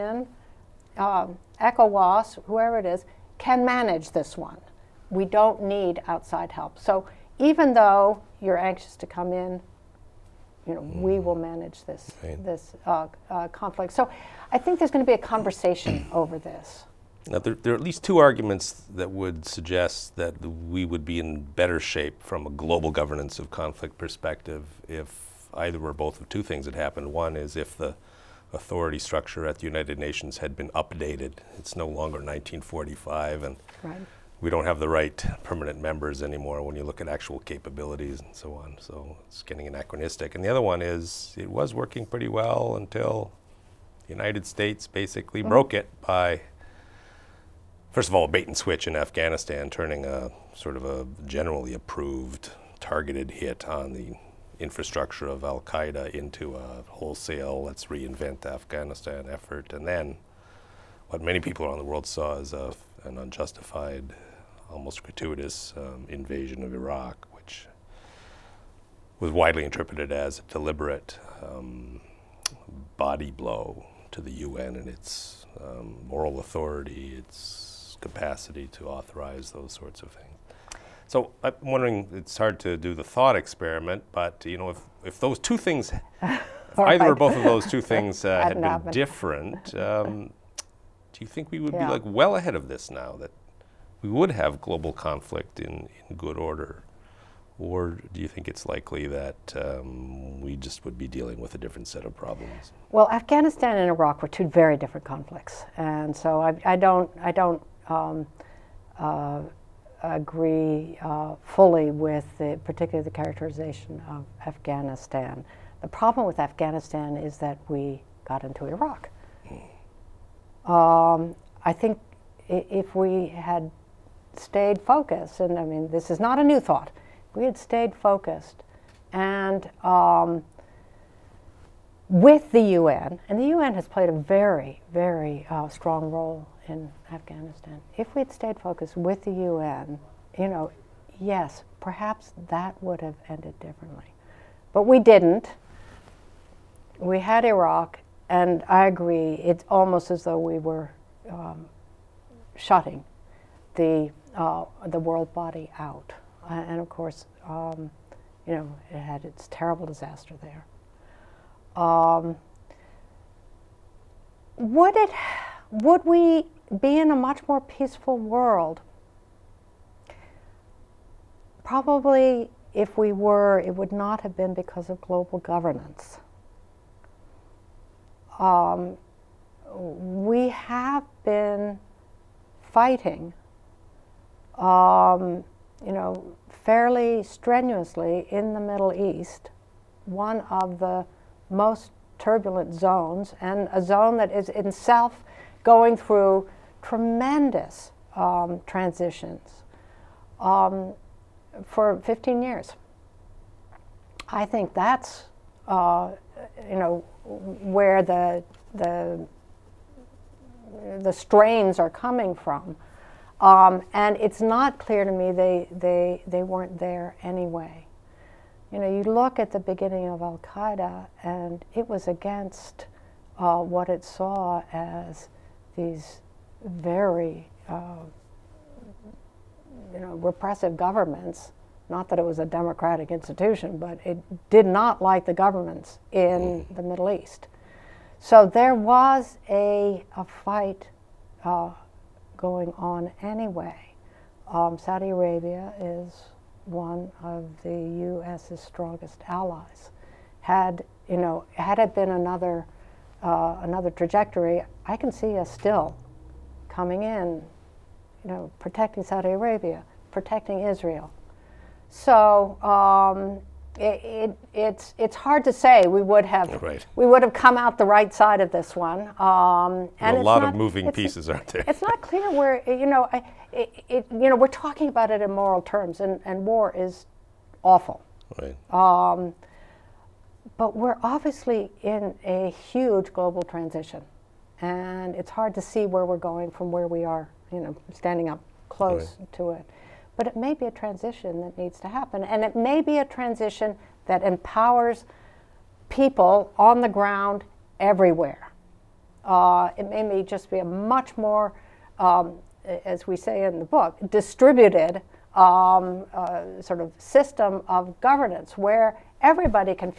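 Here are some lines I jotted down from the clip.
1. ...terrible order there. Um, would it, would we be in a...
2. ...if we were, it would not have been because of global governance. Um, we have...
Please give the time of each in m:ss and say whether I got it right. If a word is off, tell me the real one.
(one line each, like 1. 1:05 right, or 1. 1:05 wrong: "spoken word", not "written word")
1. 2:39 wrong: "disaster", not "order"
2. 2:52 right.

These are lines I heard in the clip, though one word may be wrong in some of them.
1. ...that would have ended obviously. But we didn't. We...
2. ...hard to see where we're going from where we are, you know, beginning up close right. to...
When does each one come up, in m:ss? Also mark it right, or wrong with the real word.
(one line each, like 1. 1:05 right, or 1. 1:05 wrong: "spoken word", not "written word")
1. 2:22 wrong: "differently", not "obviously"
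2. 4:45 wrong: "standing", not "beginning".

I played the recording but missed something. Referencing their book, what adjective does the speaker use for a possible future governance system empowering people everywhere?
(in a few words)
distributed.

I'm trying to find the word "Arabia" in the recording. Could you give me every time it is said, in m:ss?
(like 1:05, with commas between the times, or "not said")
4:05, 4:19.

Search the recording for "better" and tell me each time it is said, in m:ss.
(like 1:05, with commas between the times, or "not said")
0:21.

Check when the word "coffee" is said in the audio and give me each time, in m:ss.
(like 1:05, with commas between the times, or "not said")
not said.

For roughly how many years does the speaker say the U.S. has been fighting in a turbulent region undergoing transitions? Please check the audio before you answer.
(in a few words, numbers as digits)
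15.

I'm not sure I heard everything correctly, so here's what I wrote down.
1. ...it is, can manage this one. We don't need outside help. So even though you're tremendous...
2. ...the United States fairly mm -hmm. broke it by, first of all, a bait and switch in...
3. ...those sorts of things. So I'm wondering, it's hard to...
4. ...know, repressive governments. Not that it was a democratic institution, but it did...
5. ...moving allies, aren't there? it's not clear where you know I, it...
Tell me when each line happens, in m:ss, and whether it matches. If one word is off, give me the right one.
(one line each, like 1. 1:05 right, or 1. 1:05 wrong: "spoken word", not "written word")
1. 0:02 wrong: "anxious", not "tremendous"
2. 0:44 wrong: "basically", not "fairly"
3. 1:19 right
4. 3:49 right
5. 4:30 wrong: "pieces", not "allies".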